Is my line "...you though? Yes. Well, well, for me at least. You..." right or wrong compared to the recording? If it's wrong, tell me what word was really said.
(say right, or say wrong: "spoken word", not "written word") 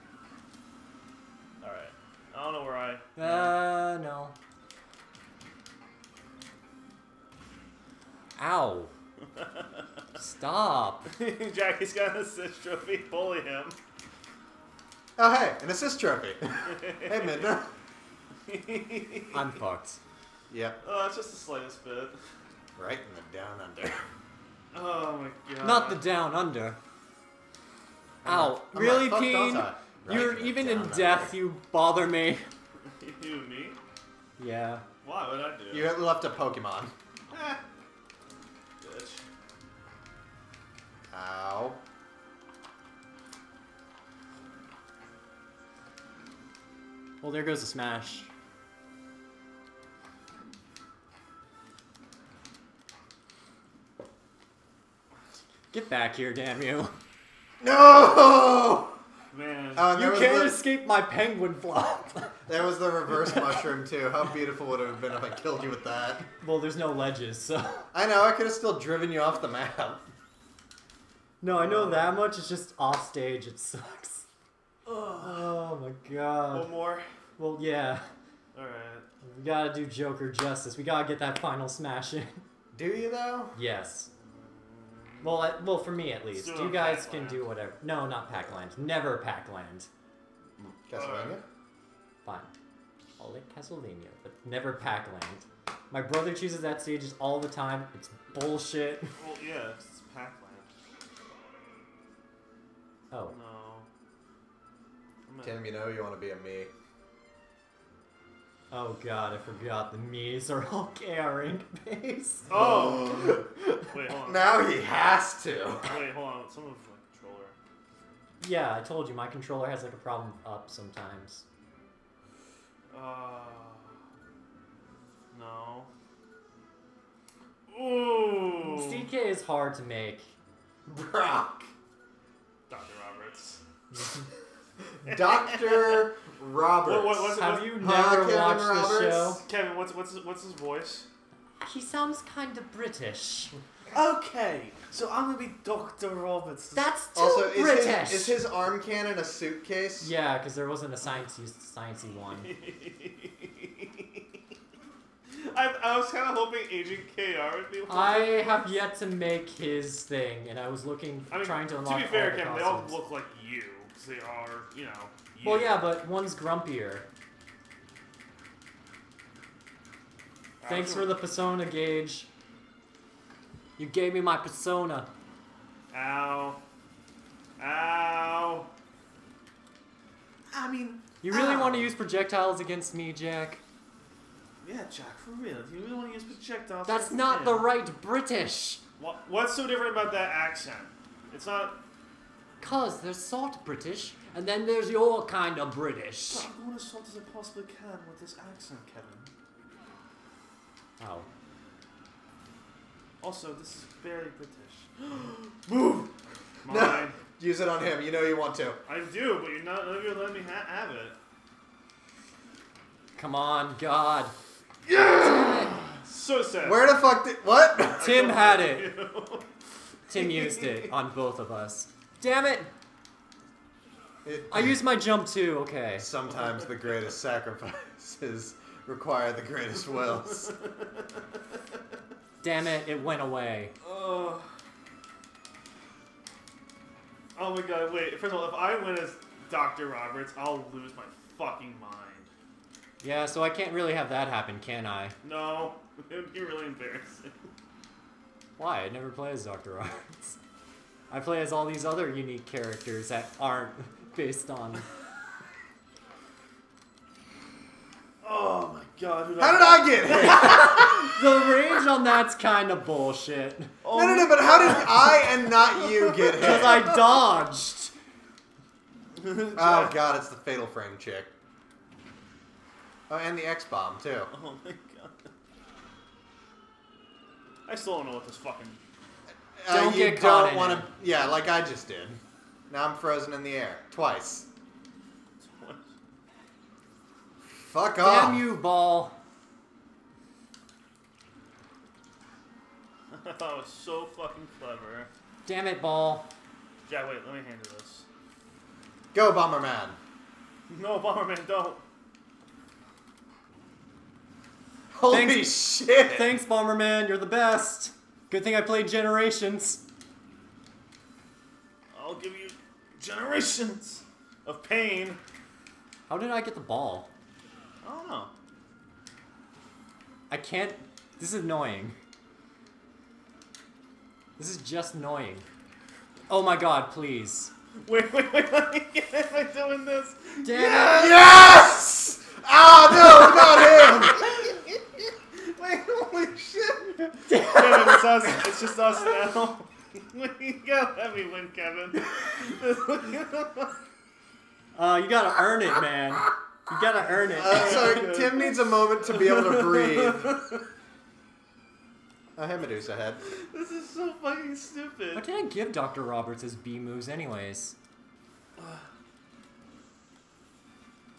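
right.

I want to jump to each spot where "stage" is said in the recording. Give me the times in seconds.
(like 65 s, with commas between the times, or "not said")
73 s, 96 s.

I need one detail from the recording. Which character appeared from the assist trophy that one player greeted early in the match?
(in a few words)
Midna.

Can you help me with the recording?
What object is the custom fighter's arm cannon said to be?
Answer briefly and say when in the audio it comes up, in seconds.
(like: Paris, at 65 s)
A suitcase, at 149 s.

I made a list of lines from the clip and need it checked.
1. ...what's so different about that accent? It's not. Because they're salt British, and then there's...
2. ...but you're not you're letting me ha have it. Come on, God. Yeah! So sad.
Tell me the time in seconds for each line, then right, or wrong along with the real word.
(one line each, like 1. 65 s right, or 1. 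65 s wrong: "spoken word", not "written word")
1. 189 s right
2. 209 s right.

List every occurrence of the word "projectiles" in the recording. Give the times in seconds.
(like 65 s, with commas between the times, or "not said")
181 s, 186 s.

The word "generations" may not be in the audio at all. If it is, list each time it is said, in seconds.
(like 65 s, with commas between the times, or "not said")
308 s, 312 s.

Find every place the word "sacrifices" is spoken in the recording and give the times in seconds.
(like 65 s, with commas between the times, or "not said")
227 s.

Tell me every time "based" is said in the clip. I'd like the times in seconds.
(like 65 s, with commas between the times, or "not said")
111 s, 254 s.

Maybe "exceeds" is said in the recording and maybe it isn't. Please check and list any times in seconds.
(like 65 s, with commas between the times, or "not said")
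not said.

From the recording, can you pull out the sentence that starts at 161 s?
To be fair, Kevin, they all look like because they are, you know.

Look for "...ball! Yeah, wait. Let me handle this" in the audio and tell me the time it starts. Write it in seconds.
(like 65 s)
295 s.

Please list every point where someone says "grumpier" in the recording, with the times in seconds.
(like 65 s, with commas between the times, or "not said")
166 s.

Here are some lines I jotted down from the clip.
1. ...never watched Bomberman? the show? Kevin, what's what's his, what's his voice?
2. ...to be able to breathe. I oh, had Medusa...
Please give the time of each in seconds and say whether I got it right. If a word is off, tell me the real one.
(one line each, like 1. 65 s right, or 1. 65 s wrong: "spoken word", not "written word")
1. 137 s wrong: "Roberts", not "Bomberman"
2. 349 s right.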